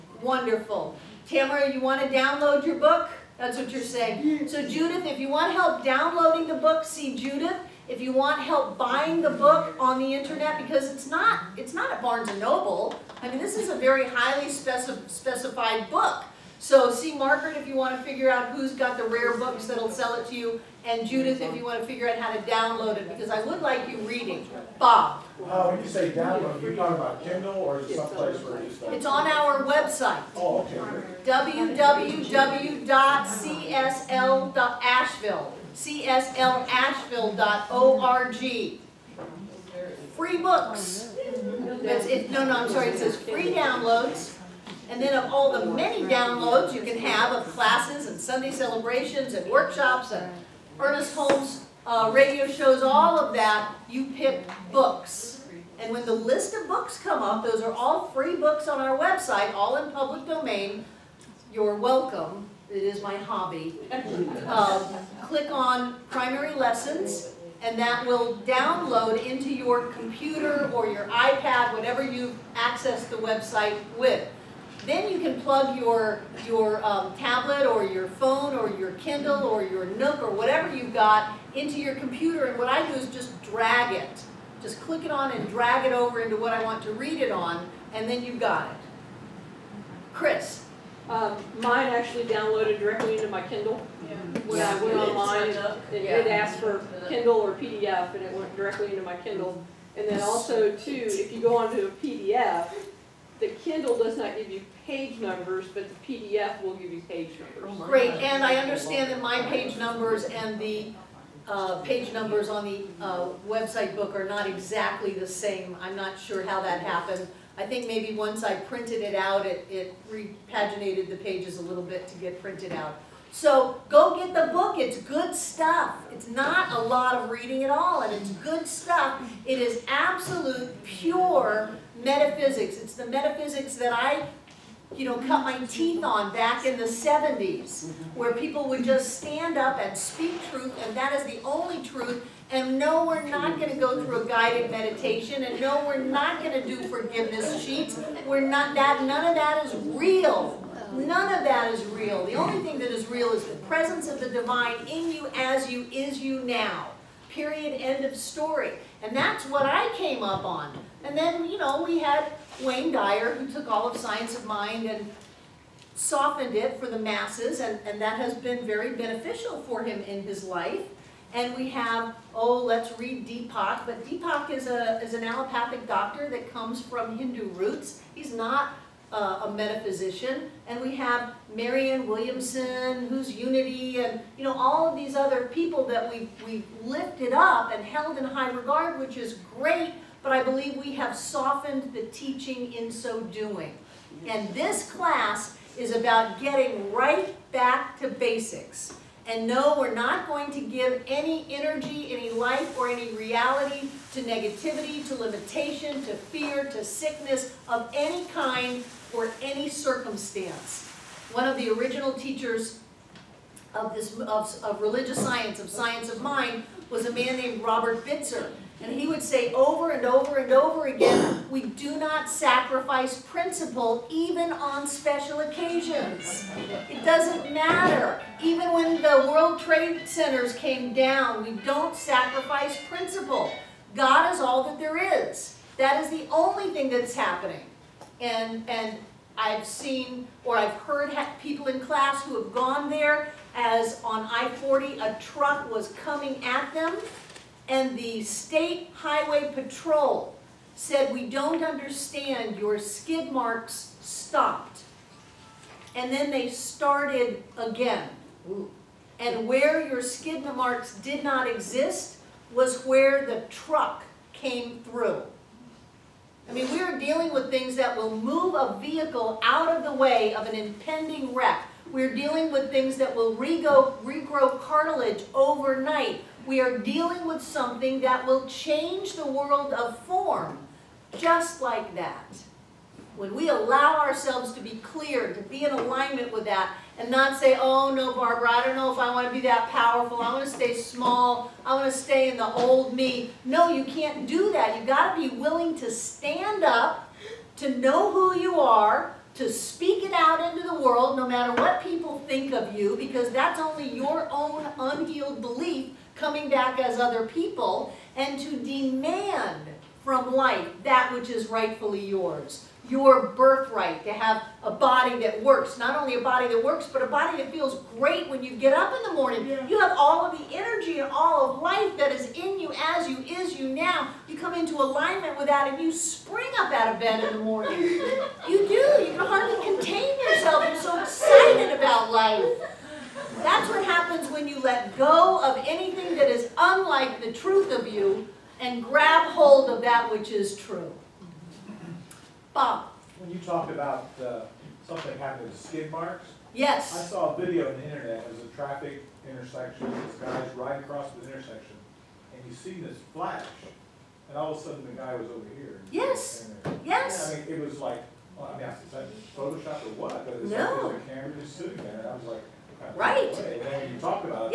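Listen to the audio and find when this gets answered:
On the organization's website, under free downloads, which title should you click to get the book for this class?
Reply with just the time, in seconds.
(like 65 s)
66 s.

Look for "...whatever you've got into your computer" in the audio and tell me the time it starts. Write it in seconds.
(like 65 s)
80 s.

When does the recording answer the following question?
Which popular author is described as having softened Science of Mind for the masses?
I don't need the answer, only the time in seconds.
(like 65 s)
162 s.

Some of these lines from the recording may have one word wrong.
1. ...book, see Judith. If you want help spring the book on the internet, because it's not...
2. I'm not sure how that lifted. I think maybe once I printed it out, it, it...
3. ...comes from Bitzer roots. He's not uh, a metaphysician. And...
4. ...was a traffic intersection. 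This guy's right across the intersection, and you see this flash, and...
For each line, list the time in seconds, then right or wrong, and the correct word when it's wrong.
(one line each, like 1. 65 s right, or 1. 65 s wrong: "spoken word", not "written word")
1. 6 s wrong: "buying", not "spring"
2. 115 s wrong: "happened", not "lifted"
3. 176 s wrong: "Hindu", not "Bitzer"
4. 348 s right.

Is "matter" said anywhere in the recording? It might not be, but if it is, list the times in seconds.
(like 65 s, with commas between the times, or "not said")
227 s, 301 s.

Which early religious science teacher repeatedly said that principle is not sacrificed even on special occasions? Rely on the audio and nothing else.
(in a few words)
Robert Bitzer.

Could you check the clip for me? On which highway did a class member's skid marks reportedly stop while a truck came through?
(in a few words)
I-40.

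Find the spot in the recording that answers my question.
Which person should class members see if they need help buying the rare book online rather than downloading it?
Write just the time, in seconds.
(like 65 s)
17 s.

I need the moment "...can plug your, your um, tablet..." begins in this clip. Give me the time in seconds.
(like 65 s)
75 s.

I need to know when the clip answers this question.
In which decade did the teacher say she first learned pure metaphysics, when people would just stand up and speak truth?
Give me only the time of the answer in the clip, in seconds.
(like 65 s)
136 s.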